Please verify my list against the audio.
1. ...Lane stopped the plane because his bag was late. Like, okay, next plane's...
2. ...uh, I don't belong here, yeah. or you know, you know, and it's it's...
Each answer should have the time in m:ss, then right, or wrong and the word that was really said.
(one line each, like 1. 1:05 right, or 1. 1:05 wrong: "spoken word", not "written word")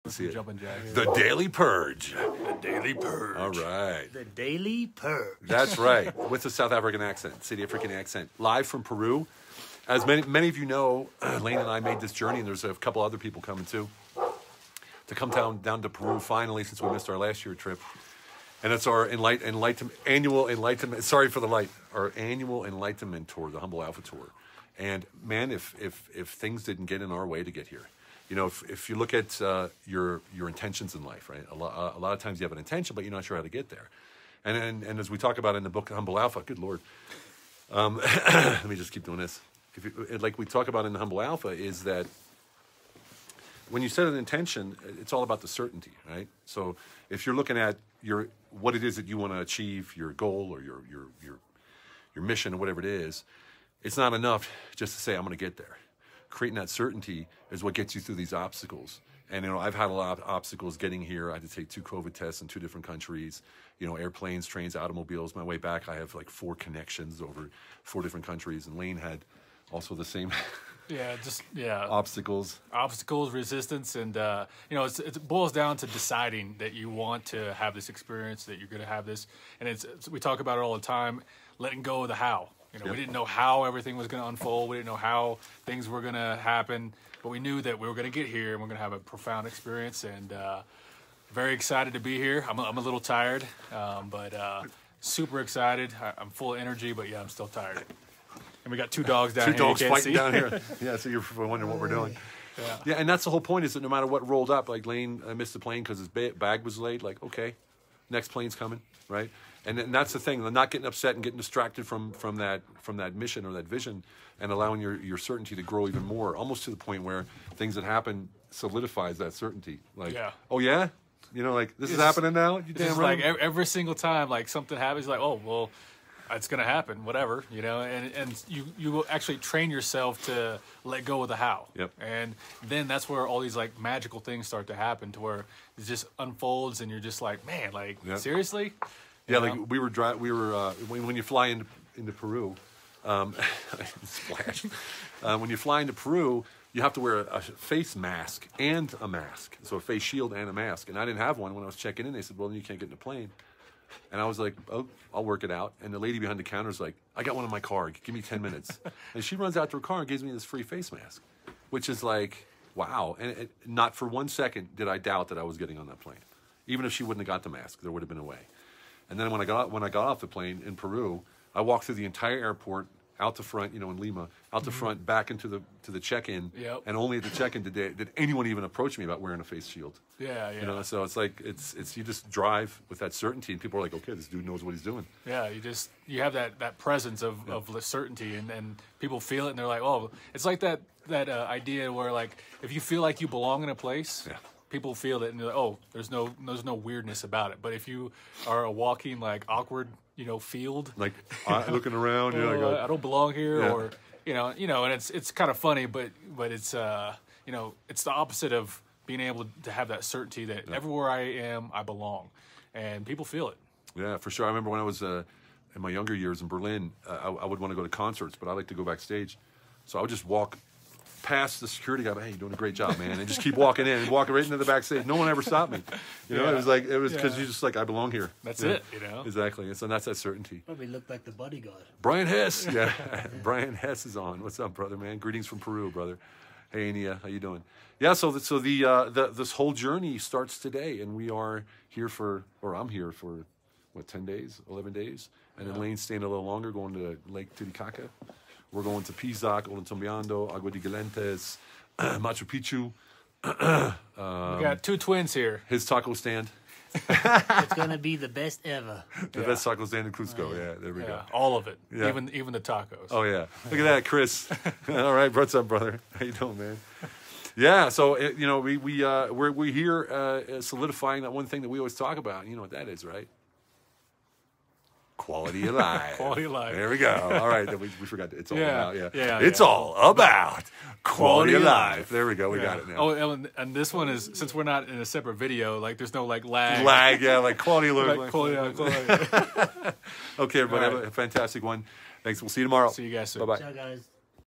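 1. 1:44 wrong: "missed", not "stopped"
2. 3:22 right.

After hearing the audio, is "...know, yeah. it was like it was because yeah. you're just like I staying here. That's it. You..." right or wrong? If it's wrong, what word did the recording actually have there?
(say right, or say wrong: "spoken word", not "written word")
wrong: "belong", not "staying".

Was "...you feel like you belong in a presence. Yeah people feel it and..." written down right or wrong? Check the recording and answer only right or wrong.
wrong.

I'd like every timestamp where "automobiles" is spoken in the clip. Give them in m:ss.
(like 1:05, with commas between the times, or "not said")
1:04.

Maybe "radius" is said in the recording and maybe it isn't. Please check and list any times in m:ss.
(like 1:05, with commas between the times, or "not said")
not said.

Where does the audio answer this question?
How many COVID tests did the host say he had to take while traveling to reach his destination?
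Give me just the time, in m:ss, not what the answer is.
1:01.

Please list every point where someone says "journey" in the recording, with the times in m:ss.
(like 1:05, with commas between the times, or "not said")
0:12, 3:59.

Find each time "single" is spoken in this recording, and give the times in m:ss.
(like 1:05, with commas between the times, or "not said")
2:03.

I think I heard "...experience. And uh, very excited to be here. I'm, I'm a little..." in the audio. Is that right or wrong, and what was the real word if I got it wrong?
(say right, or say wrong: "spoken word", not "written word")
right.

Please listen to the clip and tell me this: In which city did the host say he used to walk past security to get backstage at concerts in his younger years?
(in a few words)
Berlin.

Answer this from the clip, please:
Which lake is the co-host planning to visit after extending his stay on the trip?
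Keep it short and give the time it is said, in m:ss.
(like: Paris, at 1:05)
Lake Titicaca, at 4:07.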